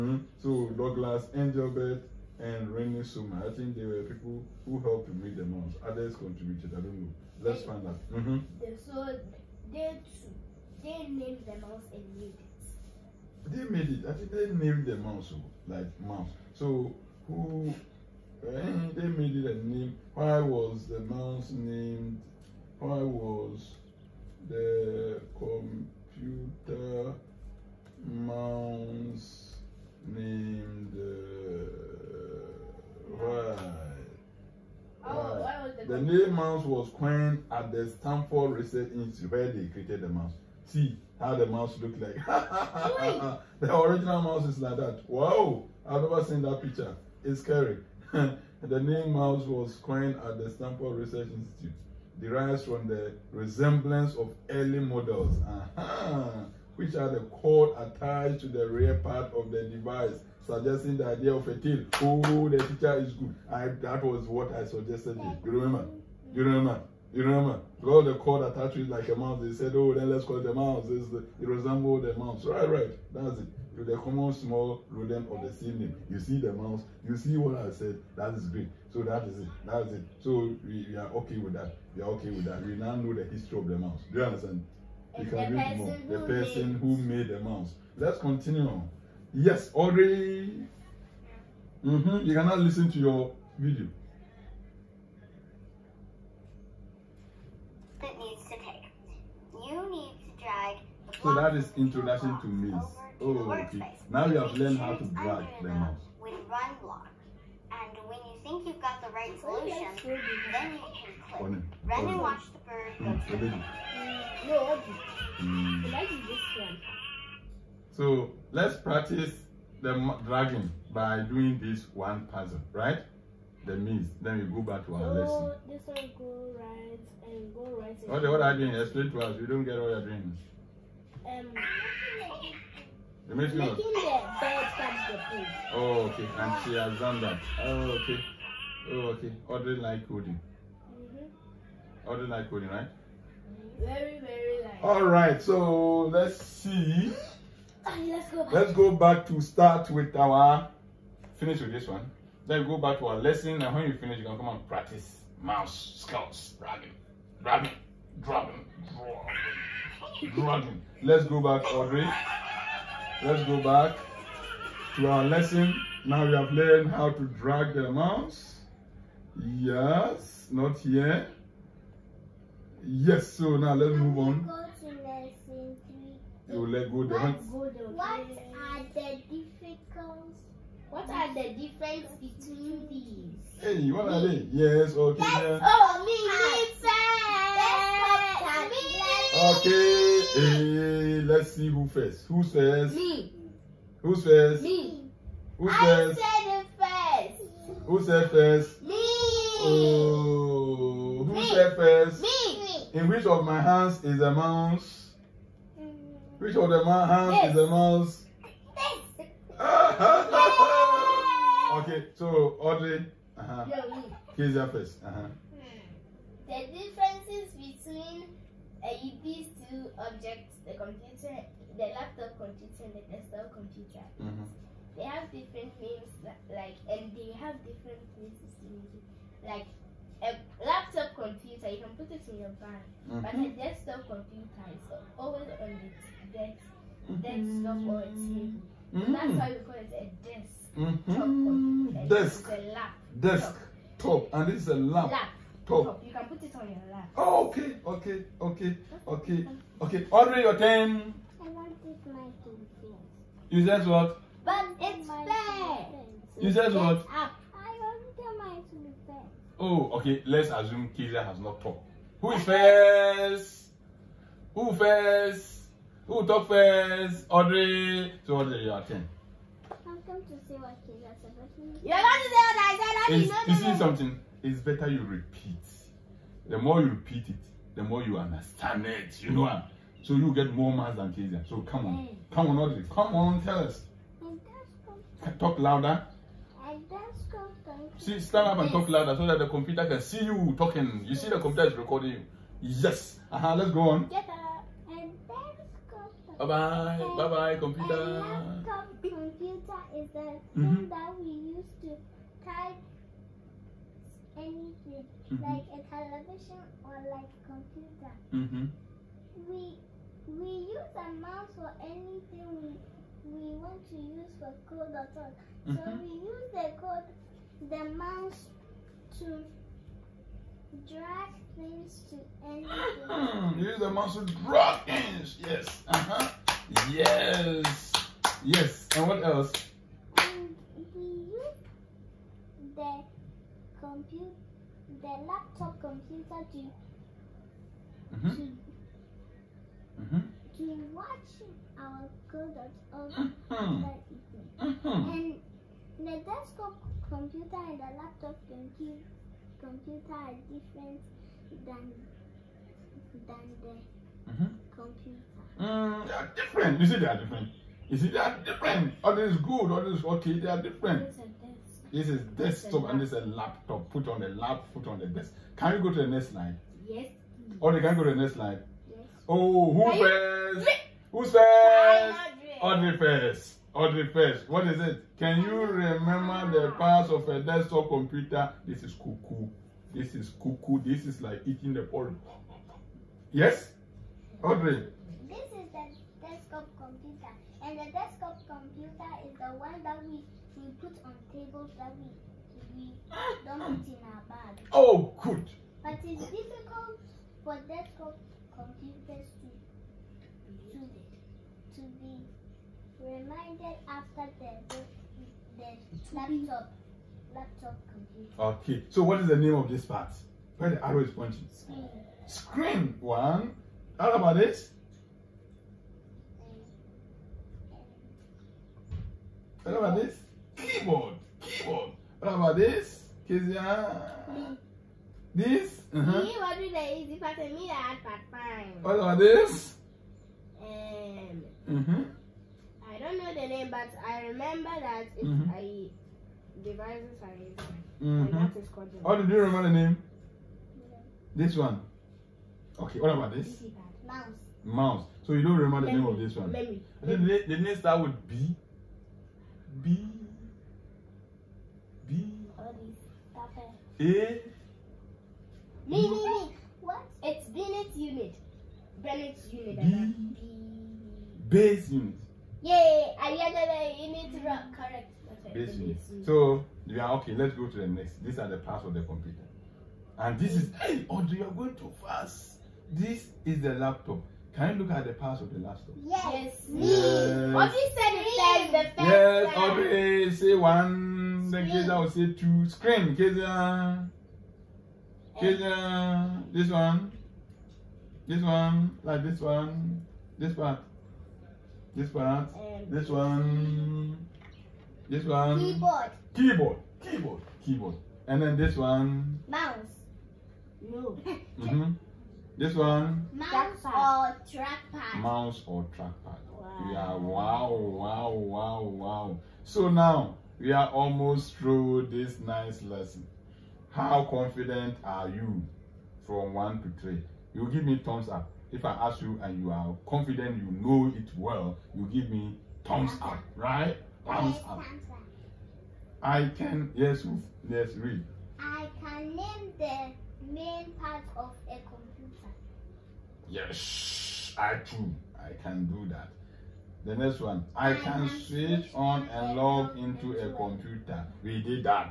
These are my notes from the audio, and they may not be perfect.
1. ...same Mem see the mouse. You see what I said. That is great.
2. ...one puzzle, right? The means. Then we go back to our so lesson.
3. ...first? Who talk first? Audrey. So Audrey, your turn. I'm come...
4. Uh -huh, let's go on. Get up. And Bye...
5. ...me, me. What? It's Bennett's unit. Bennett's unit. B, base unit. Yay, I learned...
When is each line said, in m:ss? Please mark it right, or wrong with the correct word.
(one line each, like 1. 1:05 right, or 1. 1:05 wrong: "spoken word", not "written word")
1. 1:15 wrong: "You", not "Mem"
2. 2:01 right
3. 4:24 right
4. 4:53 right
5. 7:36 right.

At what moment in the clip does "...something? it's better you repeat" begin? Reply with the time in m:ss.
4:33.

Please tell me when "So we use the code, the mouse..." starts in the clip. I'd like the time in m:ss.
5:15.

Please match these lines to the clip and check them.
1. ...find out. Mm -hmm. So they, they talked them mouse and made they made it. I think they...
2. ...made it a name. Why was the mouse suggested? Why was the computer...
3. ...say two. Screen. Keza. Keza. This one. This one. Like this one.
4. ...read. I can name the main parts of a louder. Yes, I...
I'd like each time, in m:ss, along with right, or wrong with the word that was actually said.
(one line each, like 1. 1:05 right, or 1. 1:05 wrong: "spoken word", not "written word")
1. 0:07 wrong: "named", not "talked"
2. 0:19 wrong: "named", not "suggested"
3. 8:02 right
4. 8:47 wrong: "computer", not "louder".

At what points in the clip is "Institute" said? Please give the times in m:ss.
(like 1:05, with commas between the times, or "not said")
0:38, 0:51.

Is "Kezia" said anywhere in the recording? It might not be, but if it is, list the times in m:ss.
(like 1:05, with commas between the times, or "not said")
4:41, 7:03.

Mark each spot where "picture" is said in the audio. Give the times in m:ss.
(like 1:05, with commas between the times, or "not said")
0:46, 1:02.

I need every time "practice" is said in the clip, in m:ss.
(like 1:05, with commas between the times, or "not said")
1:58, 2:34.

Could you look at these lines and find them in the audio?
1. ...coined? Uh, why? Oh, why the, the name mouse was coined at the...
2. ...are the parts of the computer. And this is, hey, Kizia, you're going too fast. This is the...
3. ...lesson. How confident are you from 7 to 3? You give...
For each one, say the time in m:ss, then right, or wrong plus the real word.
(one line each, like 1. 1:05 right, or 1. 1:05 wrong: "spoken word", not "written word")
1. 0:30 wrong: "named", not "coined"
2. 7:48 wrong: "Audrey", not "Kizia"
3. 8:32 wrong: "1", not "7".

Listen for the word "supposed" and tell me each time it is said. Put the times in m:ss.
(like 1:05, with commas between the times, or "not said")
not said.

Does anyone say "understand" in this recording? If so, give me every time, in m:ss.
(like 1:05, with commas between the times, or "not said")
1:24, 4:38.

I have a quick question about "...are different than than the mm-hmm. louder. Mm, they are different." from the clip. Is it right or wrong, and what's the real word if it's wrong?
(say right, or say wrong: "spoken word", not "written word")
wrong: "computer", not "louder".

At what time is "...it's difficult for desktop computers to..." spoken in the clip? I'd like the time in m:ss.
6:36.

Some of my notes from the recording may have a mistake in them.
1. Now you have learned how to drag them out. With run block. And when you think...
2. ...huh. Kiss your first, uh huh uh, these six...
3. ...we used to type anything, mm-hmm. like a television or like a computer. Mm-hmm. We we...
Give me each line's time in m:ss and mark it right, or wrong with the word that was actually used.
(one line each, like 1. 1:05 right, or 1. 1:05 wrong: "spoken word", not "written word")
1. 1:44 right
2. 3:33 wrong: "two", not "six"
3. 5:01 right.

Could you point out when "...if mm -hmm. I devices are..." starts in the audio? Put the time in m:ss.
7:15.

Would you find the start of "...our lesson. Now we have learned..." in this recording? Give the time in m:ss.
2:45.